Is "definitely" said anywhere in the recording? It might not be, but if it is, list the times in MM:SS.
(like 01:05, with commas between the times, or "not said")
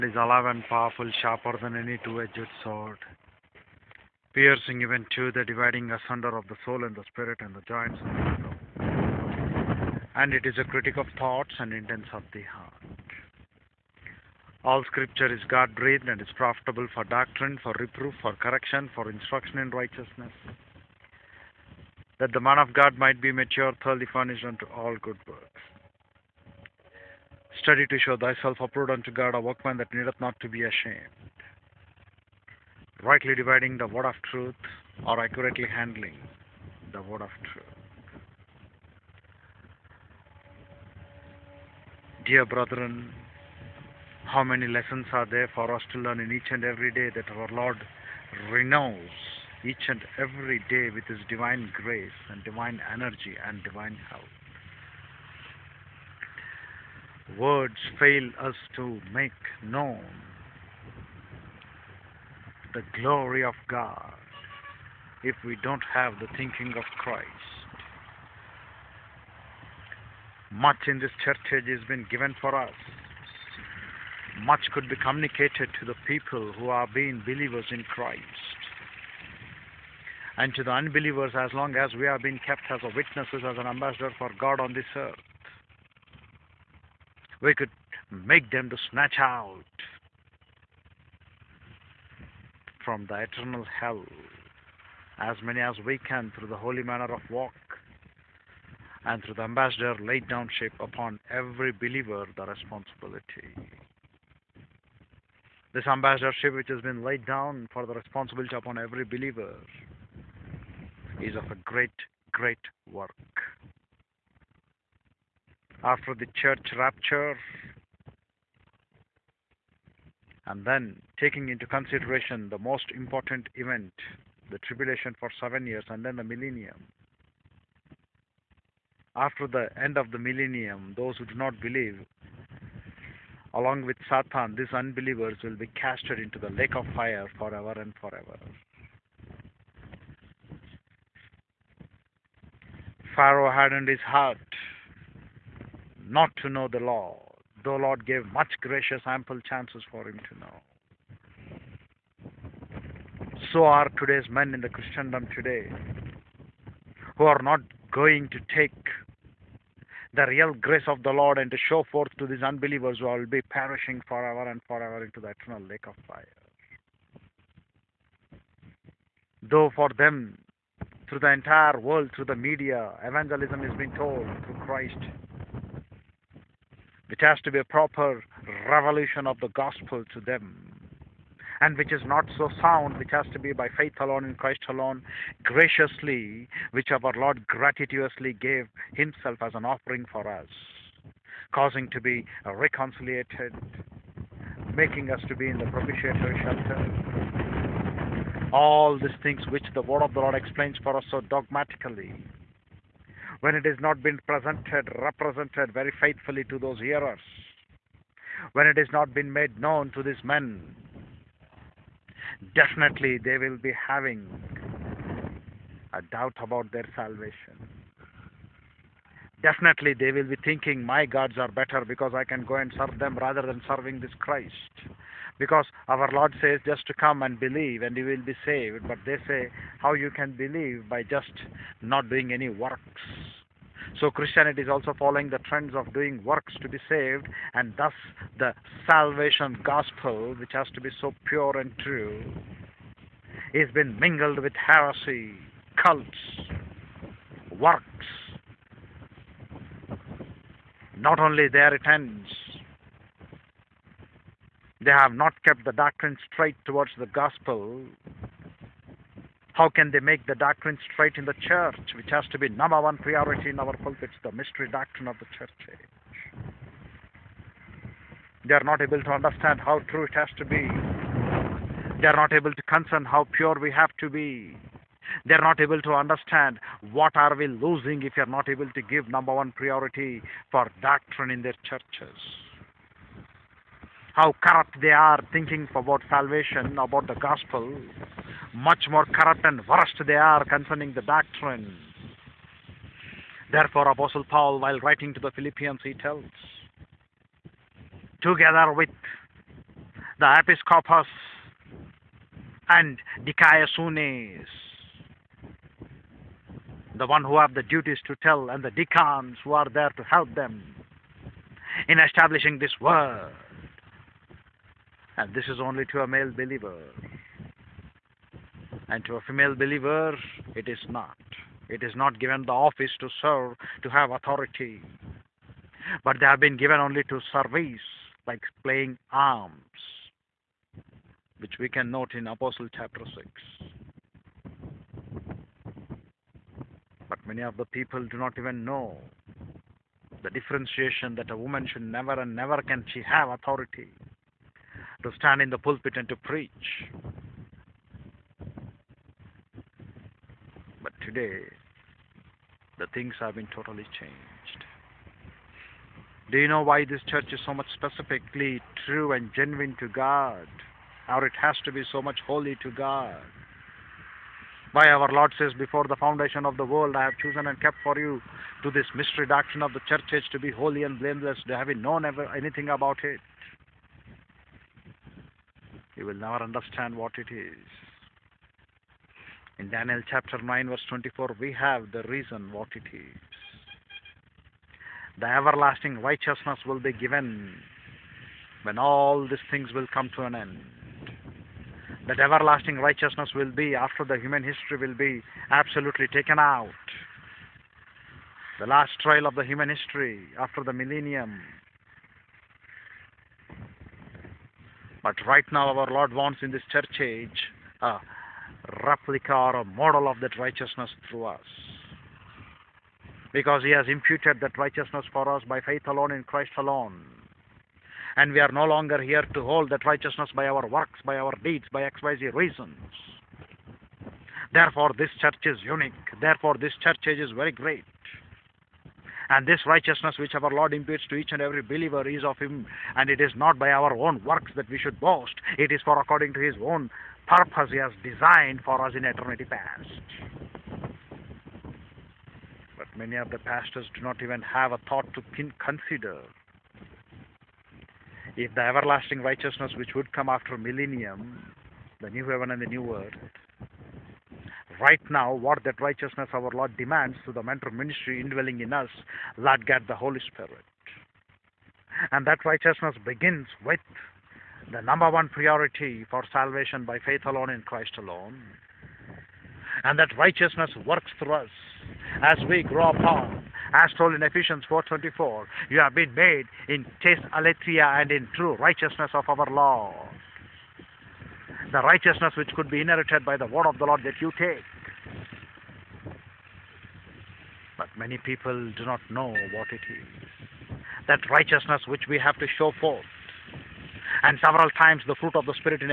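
03:32, 03:39.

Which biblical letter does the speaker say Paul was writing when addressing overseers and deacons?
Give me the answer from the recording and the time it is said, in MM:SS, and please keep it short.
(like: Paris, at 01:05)
Philippians, at 04:55.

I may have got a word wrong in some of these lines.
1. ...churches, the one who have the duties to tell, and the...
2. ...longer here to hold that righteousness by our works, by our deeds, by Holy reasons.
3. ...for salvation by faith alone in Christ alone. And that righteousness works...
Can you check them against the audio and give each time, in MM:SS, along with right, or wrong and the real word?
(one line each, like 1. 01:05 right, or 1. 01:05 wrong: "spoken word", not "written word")
1. 05:03 wrong: "dikaiasunes", not "churches"
2. 06:58 wrong: "XYZ", not "Holy"
3. 07:46 right.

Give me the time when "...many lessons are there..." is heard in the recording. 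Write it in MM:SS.
00:44.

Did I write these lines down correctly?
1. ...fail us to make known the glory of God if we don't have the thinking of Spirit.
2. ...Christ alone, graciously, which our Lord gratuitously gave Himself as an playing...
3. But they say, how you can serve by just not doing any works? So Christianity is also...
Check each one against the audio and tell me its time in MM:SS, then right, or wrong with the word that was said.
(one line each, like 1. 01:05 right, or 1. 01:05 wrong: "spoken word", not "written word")
1. 00:57 wrong: "Christ", not "Spirit"
2. 03:04 wrong: "offering", not "playing"
3. 03:48 wrong: "believe", not "serve".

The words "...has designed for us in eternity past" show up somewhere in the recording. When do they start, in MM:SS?
07:17.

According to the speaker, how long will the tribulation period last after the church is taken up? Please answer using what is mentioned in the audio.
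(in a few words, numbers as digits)
7 years.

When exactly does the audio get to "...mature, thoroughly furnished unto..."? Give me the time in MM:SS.
00:23.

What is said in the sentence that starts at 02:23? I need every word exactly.
Pharaoh hardened his heart not to know the Lord, though Lord gave much gracious ample chances for him to know.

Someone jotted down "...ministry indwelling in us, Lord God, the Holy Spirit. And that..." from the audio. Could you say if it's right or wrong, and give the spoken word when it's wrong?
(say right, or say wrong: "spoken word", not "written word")
right.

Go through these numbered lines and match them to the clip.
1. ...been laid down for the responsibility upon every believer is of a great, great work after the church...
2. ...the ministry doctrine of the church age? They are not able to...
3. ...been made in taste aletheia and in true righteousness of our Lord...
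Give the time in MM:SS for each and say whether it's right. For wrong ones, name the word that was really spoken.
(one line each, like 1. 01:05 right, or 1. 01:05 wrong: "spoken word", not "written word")
1. 01:46 right
2. 04:24 wrong: "mystery", not "ministry"
3. 07:55 right.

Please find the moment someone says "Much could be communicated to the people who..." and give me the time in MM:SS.
01:14.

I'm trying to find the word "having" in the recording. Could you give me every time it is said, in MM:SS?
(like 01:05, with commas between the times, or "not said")
03:33, 06:11.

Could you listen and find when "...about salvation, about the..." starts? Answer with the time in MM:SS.
04:45.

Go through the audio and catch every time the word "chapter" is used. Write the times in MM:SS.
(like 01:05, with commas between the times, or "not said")
05:32, 06:20.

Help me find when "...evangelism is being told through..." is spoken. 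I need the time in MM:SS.
02:53.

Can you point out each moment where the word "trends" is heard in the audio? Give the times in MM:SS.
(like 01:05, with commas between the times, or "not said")
03:55.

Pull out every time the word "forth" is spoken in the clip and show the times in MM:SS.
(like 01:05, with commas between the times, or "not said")
02:41, 08:12.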